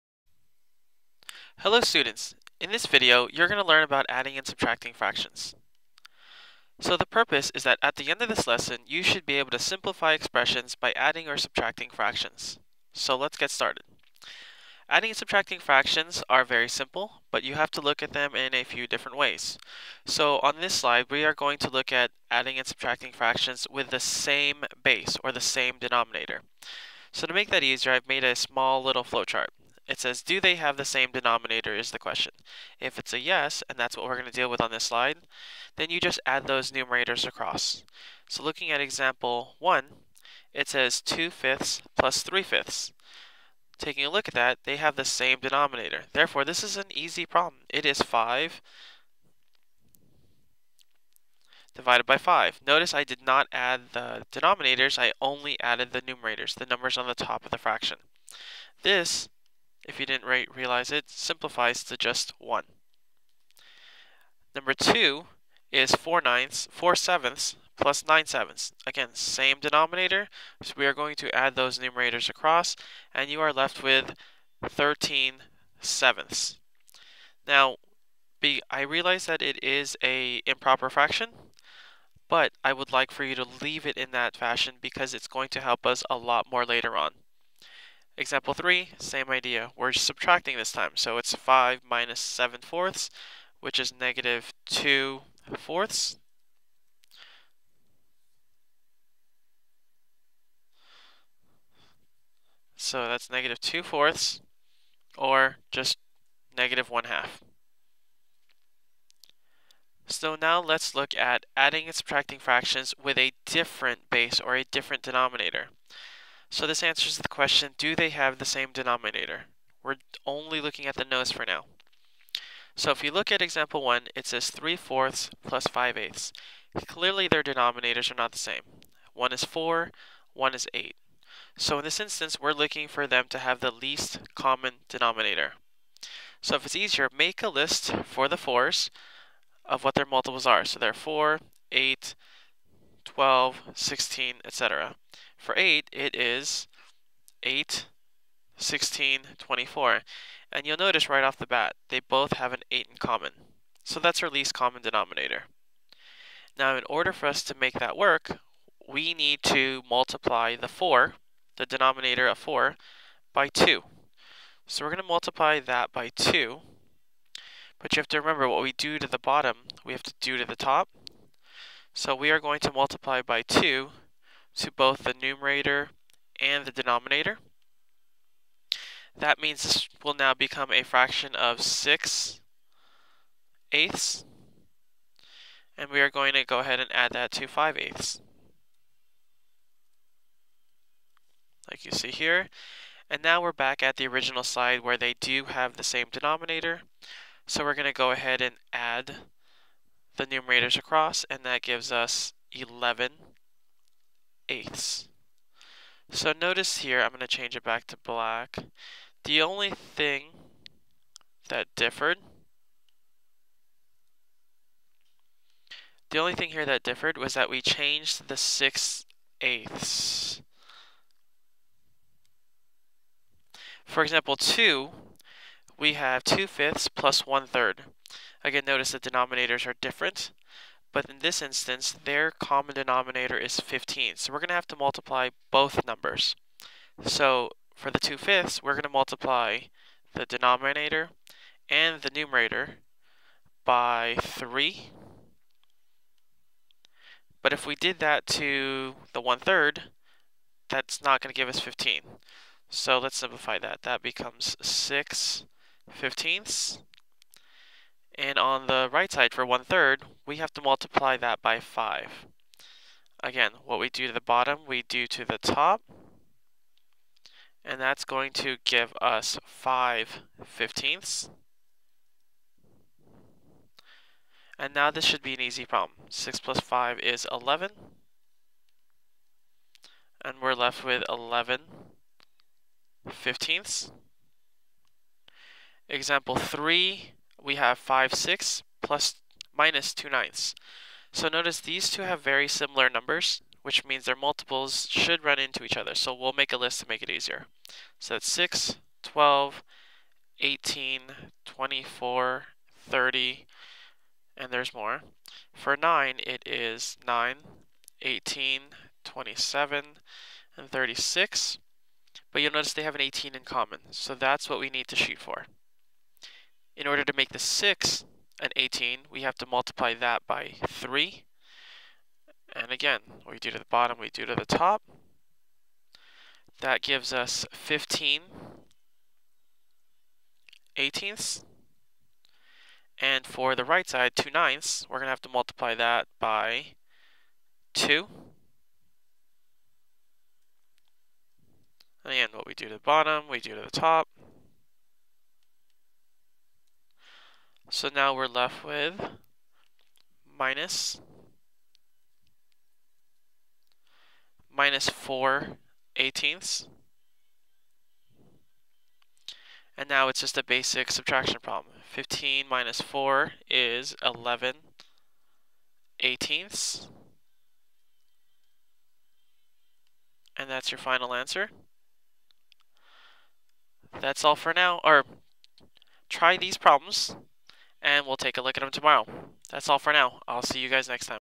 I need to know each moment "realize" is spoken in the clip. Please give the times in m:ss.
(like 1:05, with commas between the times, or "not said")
1:00, 1:18.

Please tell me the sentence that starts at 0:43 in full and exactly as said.
Taking a look at that, they have the same denominator.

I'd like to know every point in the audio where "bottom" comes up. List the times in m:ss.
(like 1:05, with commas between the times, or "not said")
2:49, 4:24, 5:23, 5:42.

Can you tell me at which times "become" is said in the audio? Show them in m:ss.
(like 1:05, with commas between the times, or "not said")
3:00, 4:14.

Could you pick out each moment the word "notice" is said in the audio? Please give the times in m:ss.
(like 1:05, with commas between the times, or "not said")
0:52, 2:30, 3:26, 3:48, 4:51, 5:12.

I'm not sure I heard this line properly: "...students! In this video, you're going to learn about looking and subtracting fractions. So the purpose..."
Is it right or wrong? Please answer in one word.
wrong.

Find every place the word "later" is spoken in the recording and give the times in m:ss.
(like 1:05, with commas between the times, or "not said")
1:26.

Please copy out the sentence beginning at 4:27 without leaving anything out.
And that's going to give us 5 fifteenths.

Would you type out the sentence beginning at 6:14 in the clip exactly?
Or try these problems and we'll take a look at them tomorrow.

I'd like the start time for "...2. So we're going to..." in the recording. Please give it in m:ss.
2:43.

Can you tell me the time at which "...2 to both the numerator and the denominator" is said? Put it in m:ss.
2:53.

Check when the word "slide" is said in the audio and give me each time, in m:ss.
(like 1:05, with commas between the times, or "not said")
0:20, 0:34.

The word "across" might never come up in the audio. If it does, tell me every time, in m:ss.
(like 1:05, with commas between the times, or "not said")
0:37, 1:12, 3:20.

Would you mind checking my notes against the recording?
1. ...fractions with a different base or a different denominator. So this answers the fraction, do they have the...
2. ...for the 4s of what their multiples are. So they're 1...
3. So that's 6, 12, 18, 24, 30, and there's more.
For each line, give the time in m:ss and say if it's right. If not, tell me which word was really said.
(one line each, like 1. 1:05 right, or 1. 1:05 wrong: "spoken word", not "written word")
1. 1:52 wrong: "question", not "fraction"
2. 2:18 wrong: "4", not "1"
3. 4:57 right.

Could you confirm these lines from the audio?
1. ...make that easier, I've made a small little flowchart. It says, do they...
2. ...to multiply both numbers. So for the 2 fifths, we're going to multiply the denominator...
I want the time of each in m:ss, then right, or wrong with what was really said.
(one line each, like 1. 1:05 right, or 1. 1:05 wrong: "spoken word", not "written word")
1. 0:27 right
2. 3:54 right.